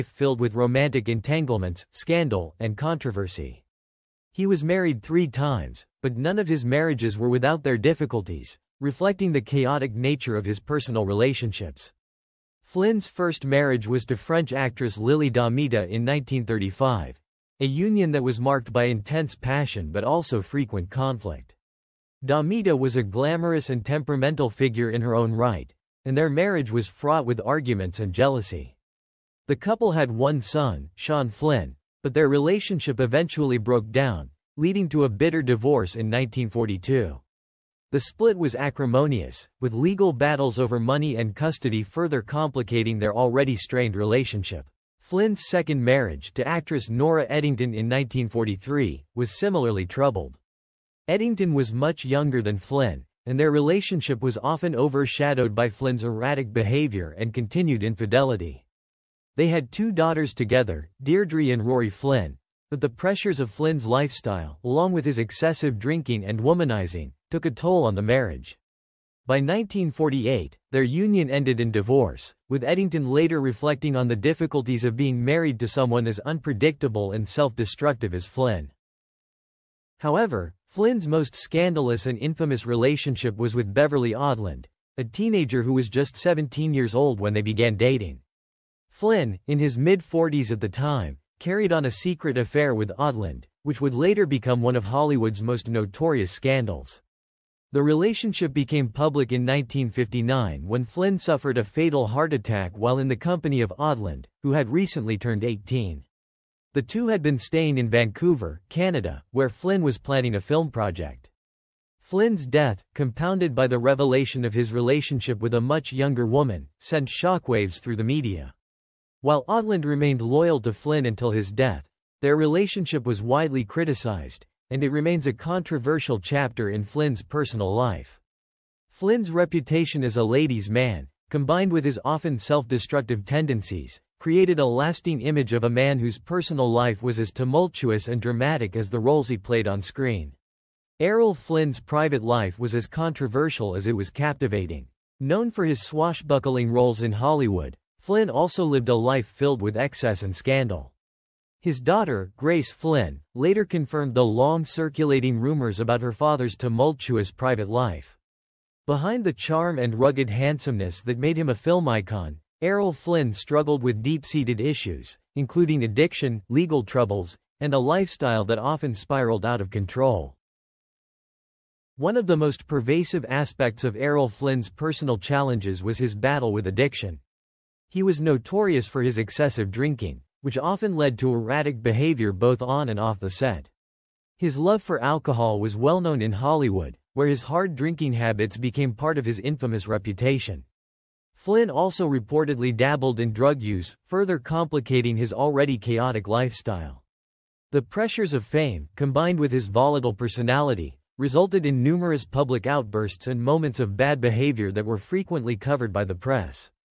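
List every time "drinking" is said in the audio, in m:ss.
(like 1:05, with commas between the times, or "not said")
1:05, 2:59, 3:07.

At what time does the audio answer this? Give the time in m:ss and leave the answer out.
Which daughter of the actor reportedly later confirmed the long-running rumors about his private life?
2:32.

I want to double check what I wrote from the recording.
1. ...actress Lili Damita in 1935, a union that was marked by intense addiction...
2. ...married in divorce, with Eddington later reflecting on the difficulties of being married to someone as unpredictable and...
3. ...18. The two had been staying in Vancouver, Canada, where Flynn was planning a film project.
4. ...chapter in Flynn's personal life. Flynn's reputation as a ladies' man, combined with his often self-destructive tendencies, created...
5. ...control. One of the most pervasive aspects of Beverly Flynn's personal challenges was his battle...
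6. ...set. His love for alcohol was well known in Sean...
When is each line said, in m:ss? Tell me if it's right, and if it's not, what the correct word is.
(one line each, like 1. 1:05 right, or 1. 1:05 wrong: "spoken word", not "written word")
1. 0:14 wrong: "passion", not "addiction"
2. 1:11 wrong: "ended", not "married"
3. 1:45 right
4. 2:06 right
5. 2:49 wrong: "Errol", not "Beverly"
6. 3:03 wrong: "Hollywood", not "Sean".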